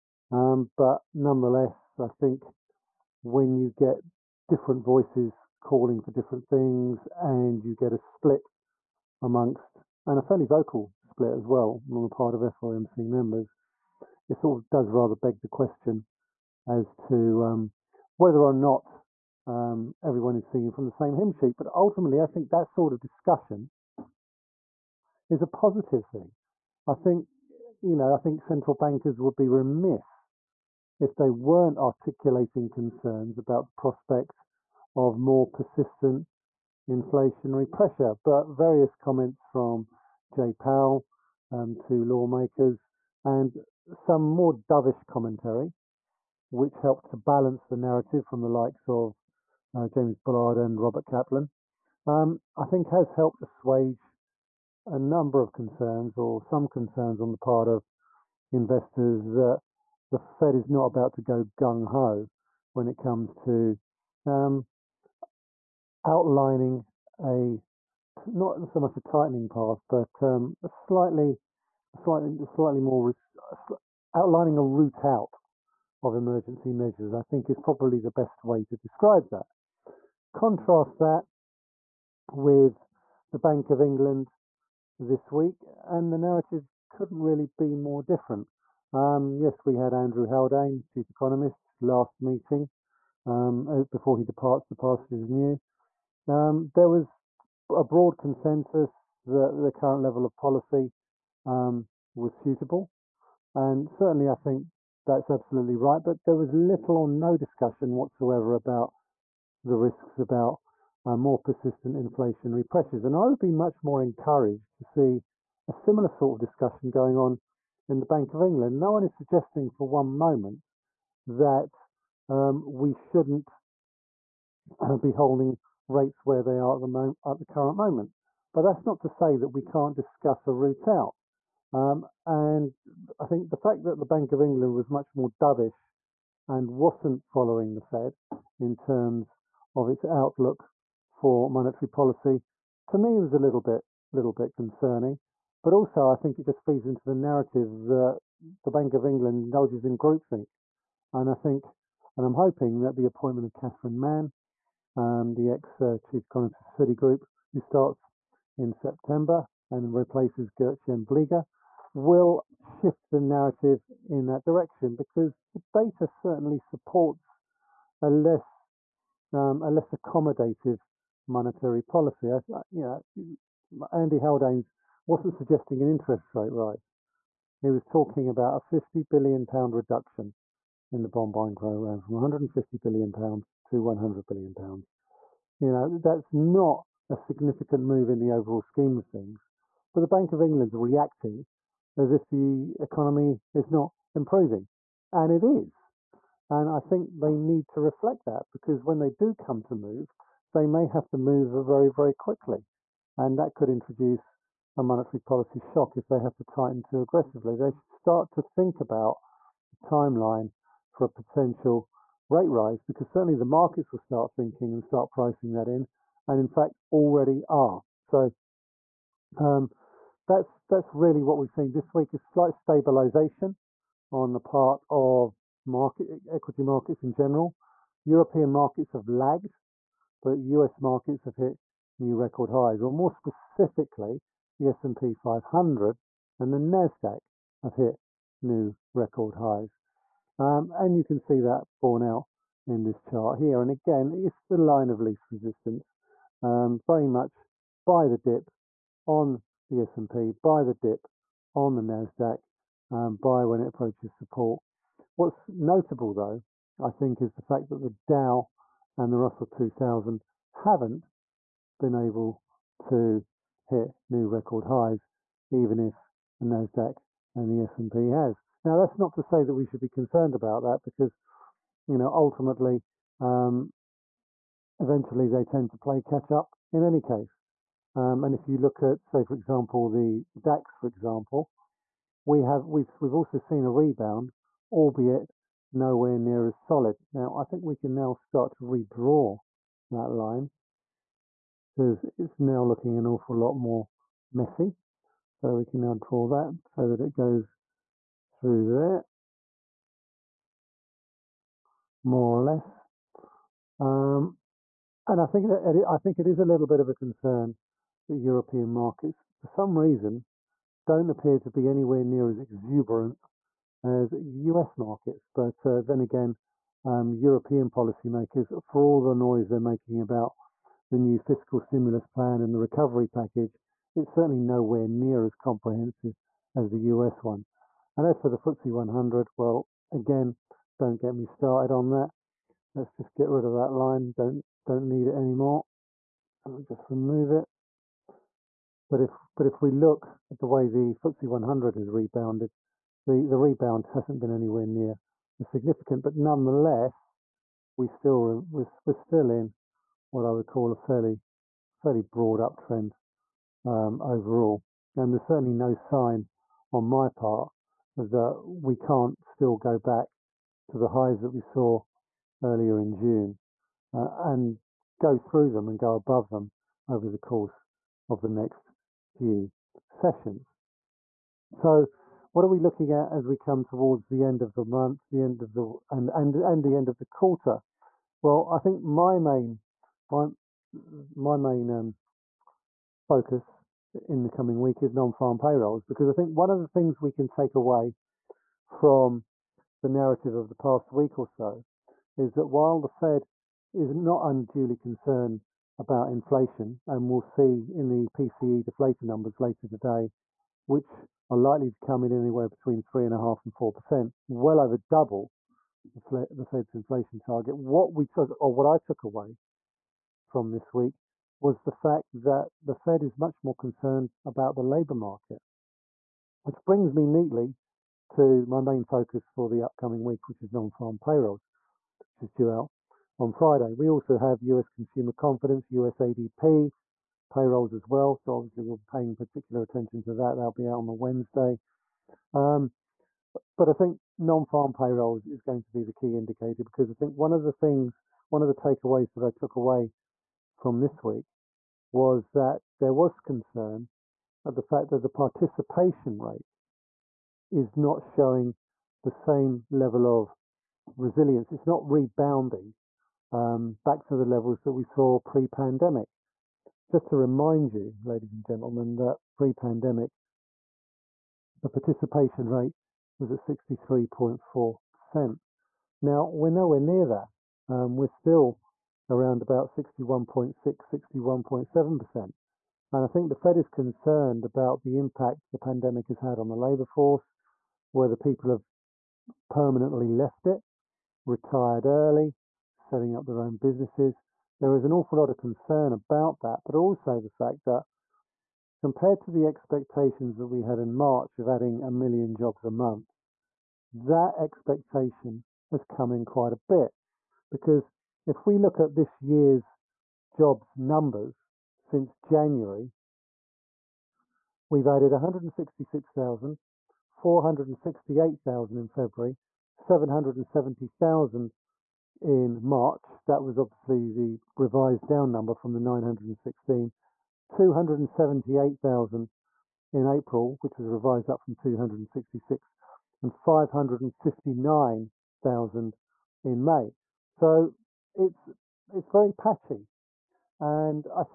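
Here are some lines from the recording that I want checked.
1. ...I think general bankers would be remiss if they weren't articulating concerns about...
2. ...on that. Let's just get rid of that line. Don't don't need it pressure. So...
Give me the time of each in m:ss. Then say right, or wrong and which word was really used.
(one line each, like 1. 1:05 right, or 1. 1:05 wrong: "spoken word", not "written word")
1. 0:28 wrong: "central", not "general"
2. 5:31 wrong: "anymore", not "pressure".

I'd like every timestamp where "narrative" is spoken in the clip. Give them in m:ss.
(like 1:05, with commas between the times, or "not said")
0:47, 1:26, 2:27, 2:43, 6:29.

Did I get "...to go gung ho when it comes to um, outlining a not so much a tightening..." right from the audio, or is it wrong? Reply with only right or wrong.
right.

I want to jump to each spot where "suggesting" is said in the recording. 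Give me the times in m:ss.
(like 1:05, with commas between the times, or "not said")
1:59, 2:55.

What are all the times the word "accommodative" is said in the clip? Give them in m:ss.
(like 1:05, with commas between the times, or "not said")
2:49.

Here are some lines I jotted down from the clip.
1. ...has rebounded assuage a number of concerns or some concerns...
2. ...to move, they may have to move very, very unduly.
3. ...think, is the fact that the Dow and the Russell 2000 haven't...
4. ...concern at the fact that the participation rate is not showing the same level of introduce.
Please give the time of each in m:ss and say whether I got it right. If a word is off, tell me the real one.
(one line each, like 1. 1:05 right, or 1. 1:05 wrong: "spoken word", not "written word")
1. 0:52 wrong: "helped", not "rebounded"
2. 3:19 wrong: "quickly", not "unduly"
3. 4:16 right
4. 7:23 wrong: "resilience", not "introduce".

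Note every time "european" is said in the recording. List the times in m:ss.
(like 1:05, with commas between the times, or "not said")
3:48, 5:08, 5:17.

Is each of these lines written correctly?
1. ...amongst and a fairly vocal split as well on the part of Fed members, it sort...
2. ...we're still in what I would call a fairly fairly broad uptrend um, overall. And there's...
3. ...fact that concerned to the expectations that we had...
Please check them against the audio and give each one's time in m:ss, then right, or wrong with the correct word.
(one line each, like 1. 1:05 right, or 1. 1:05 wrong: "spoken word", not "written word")
1. 0:09 wrong: "FOMC", not "Fed"
2. 5:48 right
3. 8:07 wrong: "compared", not "concerned".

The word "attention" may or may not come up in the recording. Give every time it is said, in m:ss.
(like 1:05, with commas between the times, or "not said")
7:09.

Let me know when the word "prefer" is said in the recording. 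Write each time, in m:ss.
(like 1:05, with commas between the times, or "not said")
not said.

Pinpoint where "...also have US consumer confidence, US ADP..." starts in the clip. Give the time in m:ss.
7:03.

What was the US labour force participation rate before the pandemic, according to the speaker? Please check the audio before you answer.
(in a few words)
63.4%.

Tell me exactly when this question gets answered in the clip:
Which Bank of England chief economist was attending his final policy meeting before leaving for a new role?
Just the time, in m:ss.
1:29.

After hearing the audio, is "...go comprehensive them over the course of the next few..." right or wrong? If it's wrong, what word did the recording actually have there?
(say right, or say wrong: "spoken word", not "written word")
wrong: "above", not "comprehensive".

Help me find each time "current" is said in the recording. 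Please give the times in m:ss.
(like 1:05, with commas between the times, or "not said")
1:39, 2:07.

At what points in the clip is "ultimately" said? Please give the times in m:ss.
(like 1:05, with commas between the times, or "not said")
0:21, 4:32.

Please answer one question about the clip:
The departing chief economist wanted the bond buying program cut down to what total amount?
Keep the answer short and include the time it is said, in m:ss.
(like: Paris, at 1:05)
100 billion pounds, at 3:03.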